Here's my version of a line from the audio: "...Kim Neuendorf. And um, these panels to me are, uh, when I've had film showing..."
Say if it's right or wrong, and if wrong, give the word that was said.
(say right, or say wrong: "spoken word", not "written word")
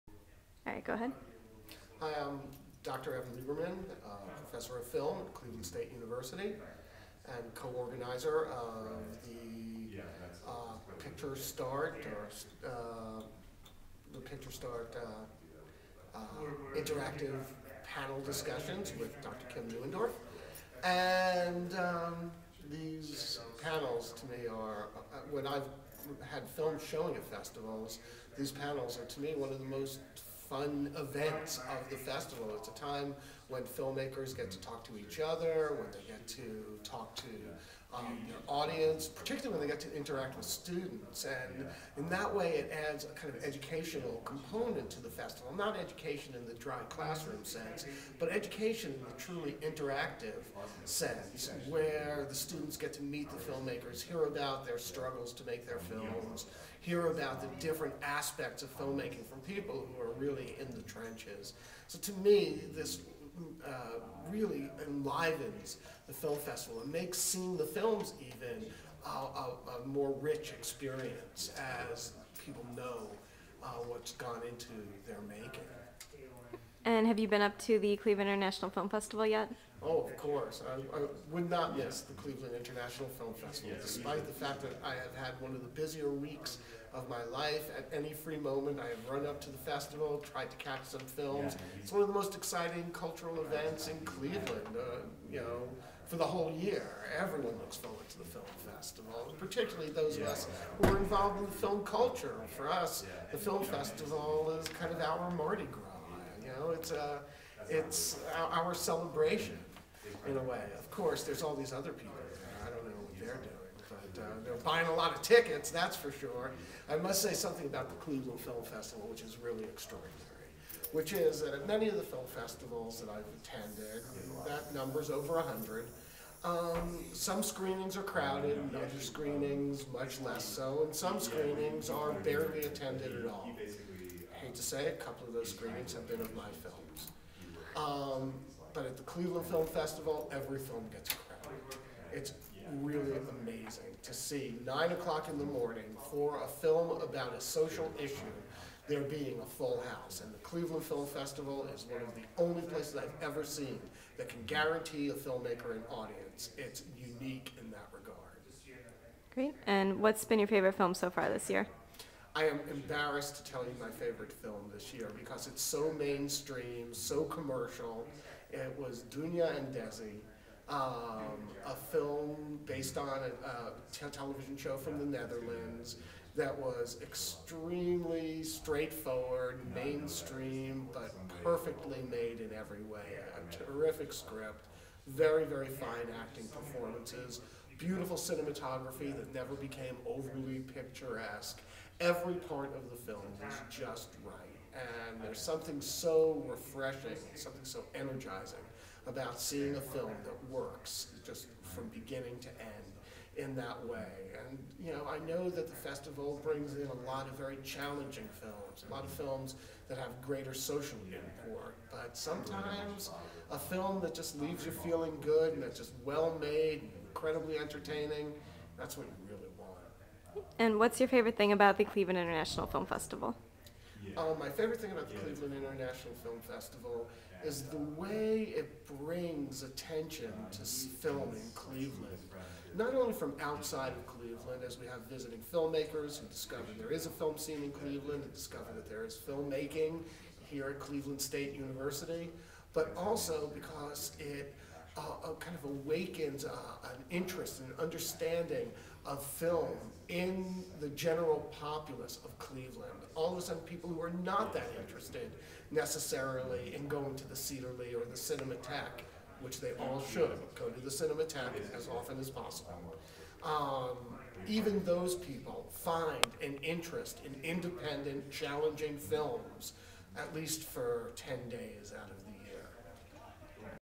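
right.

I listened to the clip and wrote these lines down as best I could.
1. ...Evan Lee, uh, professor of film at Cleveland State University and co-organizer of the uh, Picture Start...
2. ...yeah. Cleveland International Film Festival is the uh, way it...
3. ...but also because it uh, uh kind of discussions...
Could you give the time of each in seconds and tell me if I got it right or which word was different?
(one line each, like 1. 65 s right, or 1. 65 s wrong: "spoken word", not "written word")
1. 3 s wrong: "Lieberman", not "Lee"
2. 225 s right
3. 242 s wrong: "awakens", not "discussions".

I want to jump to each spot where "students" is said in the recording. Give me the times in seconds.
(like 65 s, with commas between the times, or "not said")
40 s, 52 s.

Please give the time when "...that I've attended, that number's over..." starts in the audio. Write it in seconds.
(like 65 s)
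123 s.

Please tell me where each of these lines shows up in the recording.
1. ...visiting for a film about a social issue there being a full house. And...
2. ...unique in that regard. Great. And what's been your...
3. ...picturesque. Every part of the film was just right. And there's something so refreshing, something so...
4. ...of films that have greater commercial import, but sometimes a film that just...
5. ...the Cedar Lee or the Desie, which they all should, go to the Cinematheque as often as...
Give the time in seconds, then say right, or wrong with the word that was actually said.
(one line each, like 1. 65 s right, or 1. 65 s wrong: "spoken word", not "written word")
1. 145 s wrong: "morning", not "visiting"
2. 156 s right
3. 190 s right
4. 209 s wrong: "social", not "commercial"
5. 257 s wrong: "Cinematheque", not "Desie".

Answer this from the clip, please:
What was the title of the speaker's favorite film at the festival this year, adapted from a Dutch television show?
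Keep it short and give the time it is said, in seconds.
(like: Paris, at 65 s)
Dunya and Desie, at 169 s.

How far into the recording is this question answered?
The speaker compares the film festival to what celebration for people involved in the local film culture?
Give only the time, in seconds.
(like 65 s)
105 s.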